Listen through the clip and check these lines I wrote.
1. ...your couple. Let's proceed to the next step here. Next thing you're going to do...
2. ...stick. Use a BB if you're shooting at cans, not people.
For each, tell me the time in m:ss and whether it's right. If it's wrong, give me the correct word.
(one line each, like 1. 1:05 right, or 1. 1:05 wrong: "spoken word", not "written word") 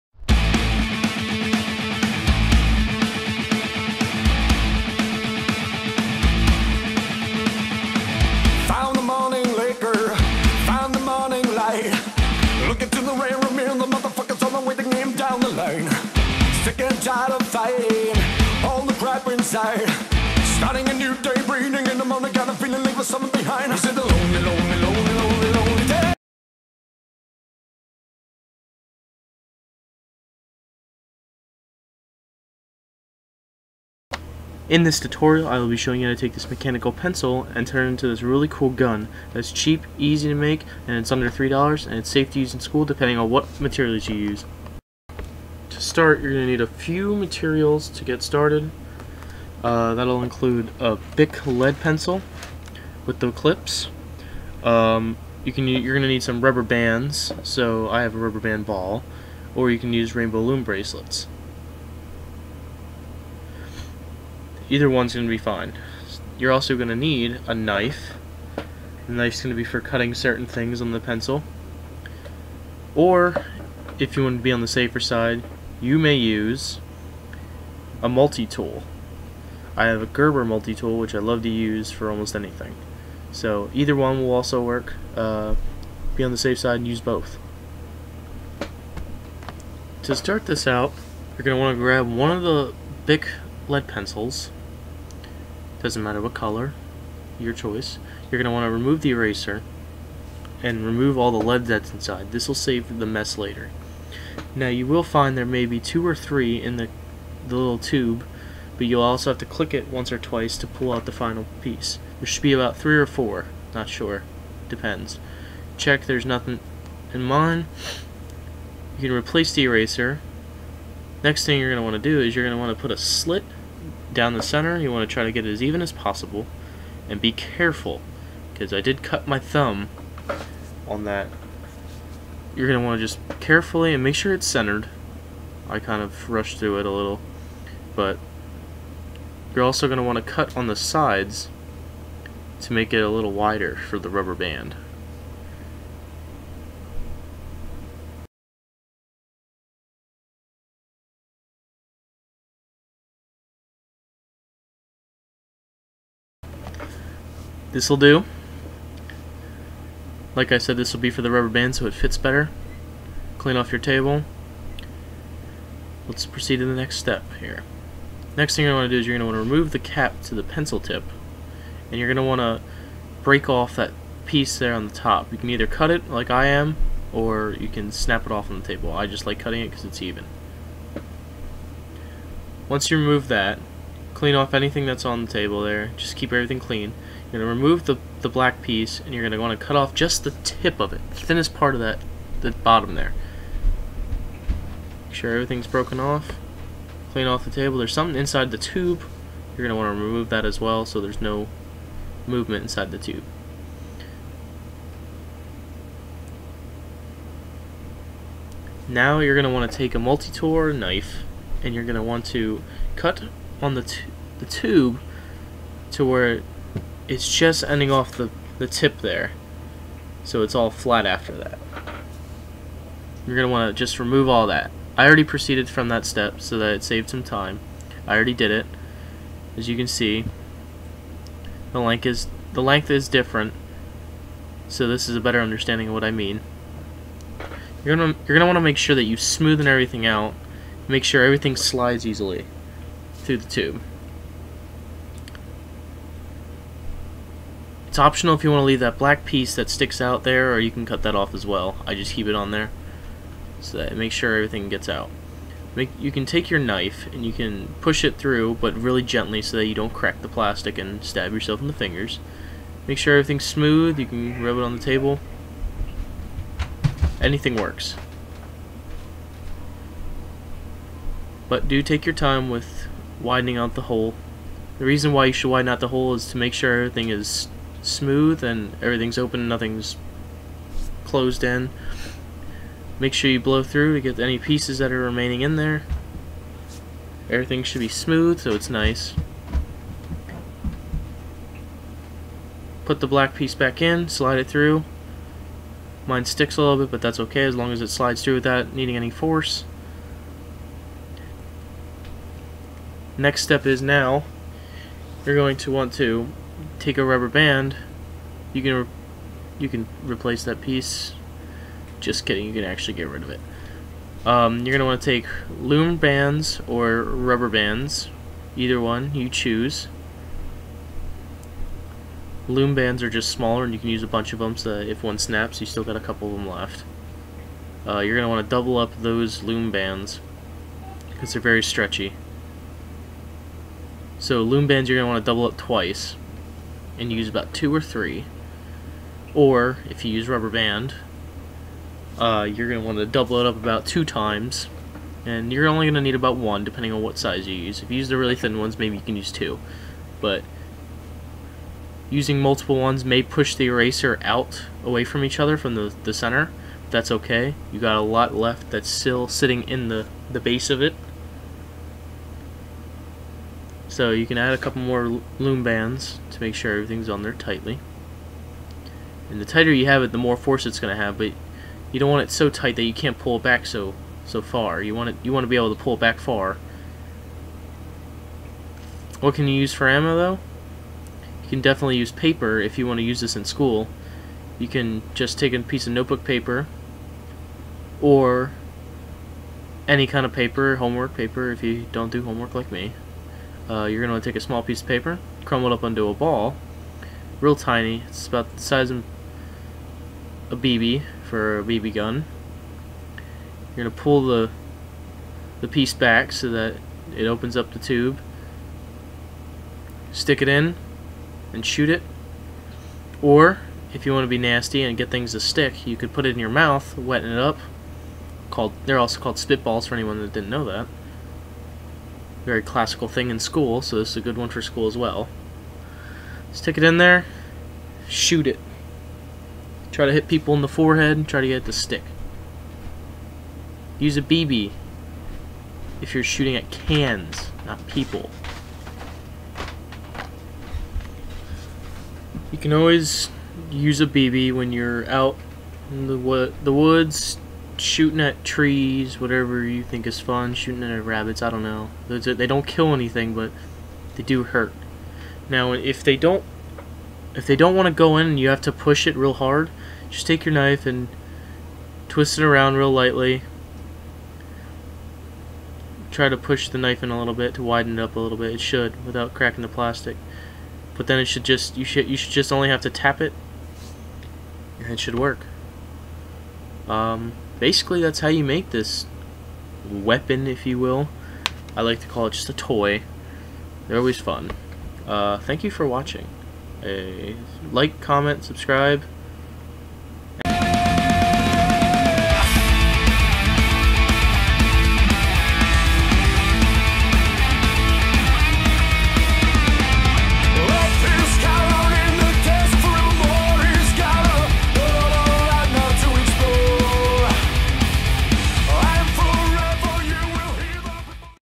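1. 2:43 wrong: "table", not "couple"
2. 7:11 right.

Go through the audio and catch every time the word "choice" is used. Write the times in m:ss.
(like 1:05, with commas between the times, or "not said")
1:37.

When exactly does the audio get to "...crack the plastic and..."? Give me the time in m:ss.
4:19.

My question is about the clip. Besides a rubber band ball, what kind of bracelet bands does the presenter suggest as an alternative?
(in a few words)
rainbow loom bracelets.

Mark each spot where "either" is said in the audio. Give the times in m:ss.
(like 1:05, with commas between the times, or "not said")
1:04, 1:23, 2:55, 5:18.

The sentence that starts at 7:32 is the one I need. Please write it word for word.
They don't kill anything, but they do hurt.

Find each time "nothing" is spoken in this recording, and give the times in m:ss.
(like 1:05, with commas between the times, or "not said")
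1:56, 4:39.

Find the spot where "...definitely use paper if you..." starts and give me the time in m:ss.
6:21.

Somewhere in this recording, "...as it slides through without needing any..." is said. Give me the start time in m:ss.
4:57.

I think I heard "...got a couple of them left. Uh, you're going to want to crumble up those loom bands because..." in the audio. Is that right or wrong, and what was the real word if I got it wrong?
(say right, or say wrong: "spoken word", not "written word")
wrong: "double", not "crumble".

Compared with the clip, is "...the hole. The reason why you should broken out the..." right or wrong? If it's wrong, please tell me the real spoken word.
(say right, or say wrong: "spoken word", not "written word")
wrong: "widen", not "broken".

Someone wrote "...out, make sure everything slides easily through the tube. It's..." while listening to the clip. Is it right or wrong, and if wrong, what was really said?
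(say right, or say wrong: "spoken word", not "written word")
right.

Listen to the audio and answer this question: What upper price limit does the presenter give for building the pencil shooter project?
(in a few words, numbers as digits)
$3.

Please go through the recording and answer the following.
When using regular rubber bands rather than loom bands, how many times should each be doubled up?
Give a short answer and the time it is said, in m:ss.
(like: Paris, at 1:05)
2, at 5:43.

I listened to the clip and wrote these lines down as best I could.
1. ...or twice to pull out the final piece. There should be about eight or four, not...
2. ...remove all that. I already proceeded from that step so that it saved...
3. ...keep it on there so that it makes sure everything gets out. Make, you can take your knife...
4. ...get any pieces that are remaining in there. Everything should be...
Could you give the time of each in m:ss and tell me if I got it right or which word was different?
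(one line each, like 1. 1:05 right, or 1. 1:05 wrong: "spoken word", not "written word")
1. 1:50 wrong: "three", not "eight"
2. 3:43 right
3. 4:12 right
4. 4:44 right.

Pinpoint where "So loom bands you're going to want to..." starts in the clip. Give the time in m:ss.
5:34.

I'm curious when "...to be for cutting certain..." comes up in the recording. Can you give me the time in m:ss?
1:09.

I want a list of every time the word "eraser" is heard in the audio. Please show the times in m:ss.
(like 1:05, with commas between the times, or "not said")
1:39, 1:59, 5:53.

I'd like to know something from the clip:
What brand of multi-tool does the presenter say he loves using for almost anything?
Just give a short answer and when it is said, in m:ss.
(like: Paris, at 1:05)
Gerber, at 1:20.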